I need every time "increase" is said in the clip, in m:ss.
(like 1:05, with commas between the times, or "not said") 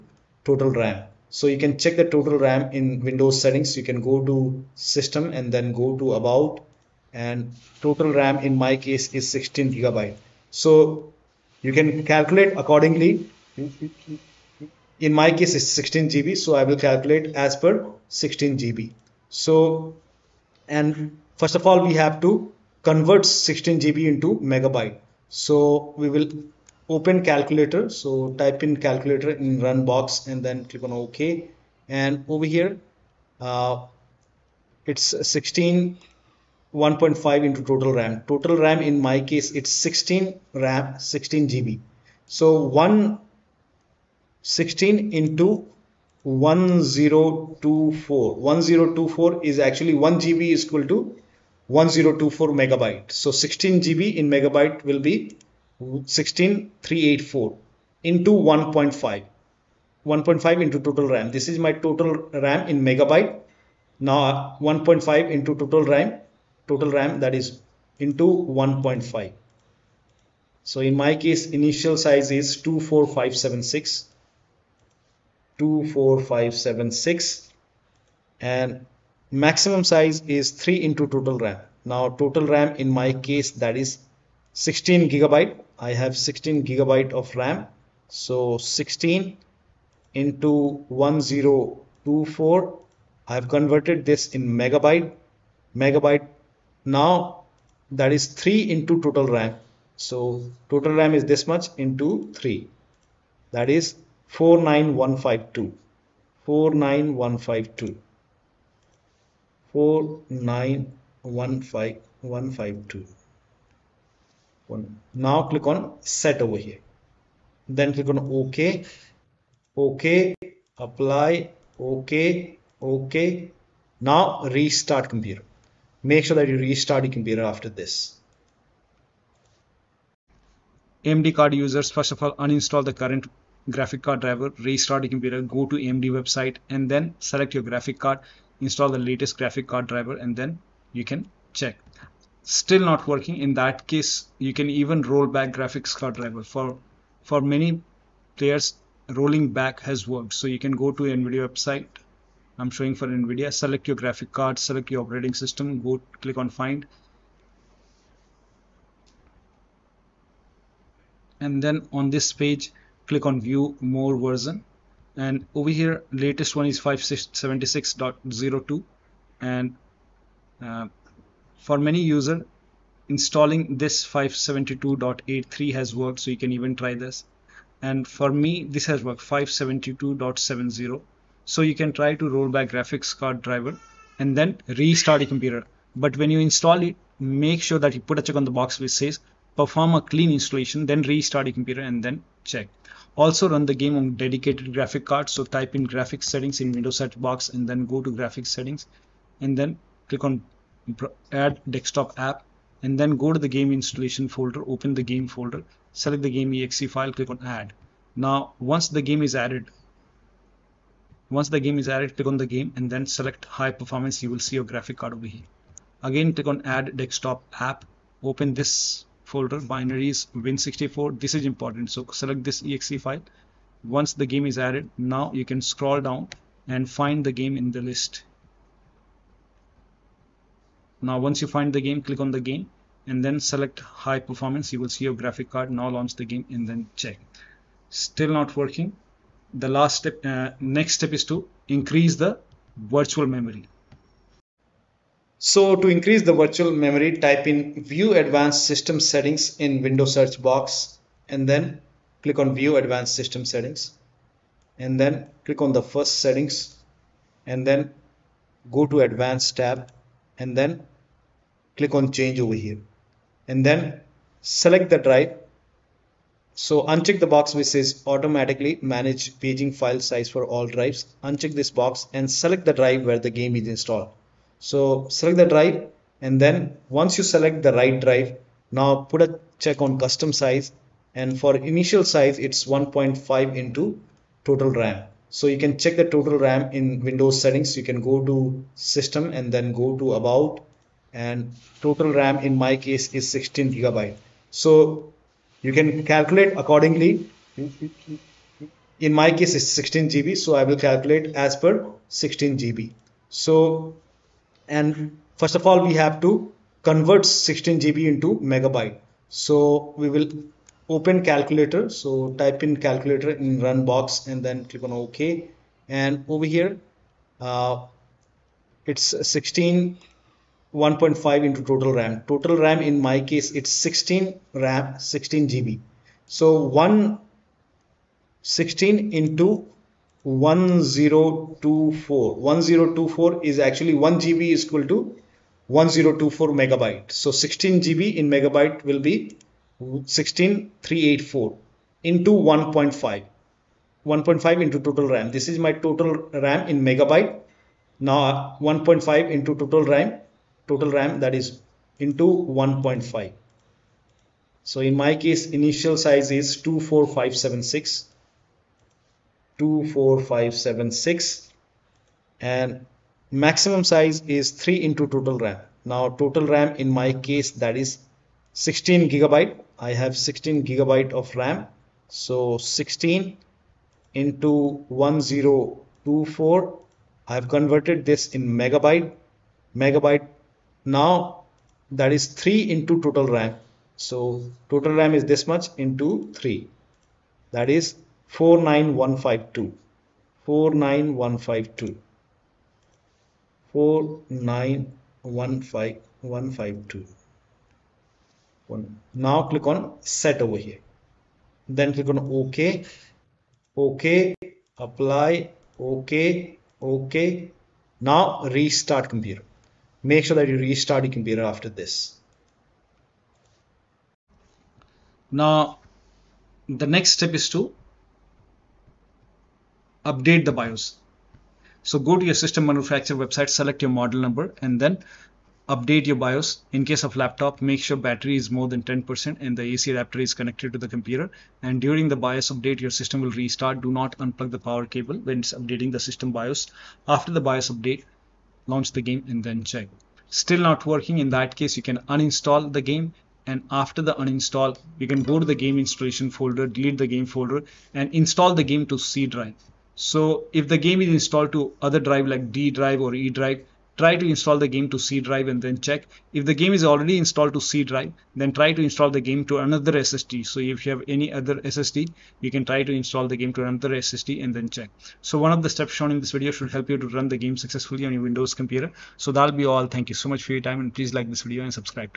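4:01, 4:05.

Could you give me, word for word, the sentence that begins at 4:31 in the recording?
Uncheck this box and select the drive where the game is installed.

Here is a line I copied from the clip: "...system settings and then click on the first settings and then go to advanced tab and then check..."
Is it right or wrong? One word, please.
wrong.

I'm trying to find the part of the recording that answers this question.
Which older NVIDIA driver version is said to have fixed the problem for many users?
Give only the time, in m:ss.
2:54.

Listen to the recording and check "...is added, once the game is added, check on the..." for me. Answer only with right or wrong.
wrong.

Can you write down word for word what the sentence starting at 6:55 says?
Now, the next step is to update the BIOS.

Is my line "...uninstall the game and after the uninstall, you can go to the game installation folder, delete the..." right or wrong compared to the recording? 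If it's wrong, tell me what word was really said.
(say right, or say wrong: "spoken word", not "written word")
right.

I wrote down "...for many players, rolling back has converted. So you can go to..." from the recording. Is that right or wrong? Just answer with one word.
wrong.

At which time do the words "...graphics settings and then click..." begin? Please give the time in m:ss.
3:18.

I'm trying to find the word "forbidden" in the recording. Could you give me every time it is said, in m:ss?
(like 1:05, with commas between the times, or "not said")
not said.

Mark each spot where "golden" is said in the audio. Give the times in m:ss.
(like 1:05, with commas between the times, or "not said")
not said.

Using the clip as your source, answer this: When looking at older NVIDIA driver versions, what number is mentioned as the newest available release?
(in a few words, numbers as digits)
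576.02.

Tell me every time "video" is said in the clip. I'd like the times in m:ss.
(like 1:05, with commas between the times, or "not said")
7:46, 7:51.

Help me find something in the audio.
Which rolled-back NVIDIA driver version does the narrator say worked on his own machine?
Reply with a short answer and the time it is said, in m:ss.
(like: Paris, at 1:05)
572.70, at 2:59.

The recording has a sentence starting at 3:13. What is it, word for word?
Also run the game on dedicated graphic card.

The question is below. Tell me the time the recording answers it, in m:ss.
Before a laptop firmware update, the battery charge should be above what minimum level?
7:08.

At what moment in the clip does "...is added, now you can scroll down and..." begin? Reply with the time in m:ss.
3:44.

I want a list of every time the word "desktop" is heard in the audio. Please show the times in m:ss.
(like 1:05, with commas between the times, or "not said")
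3:21, 3:36.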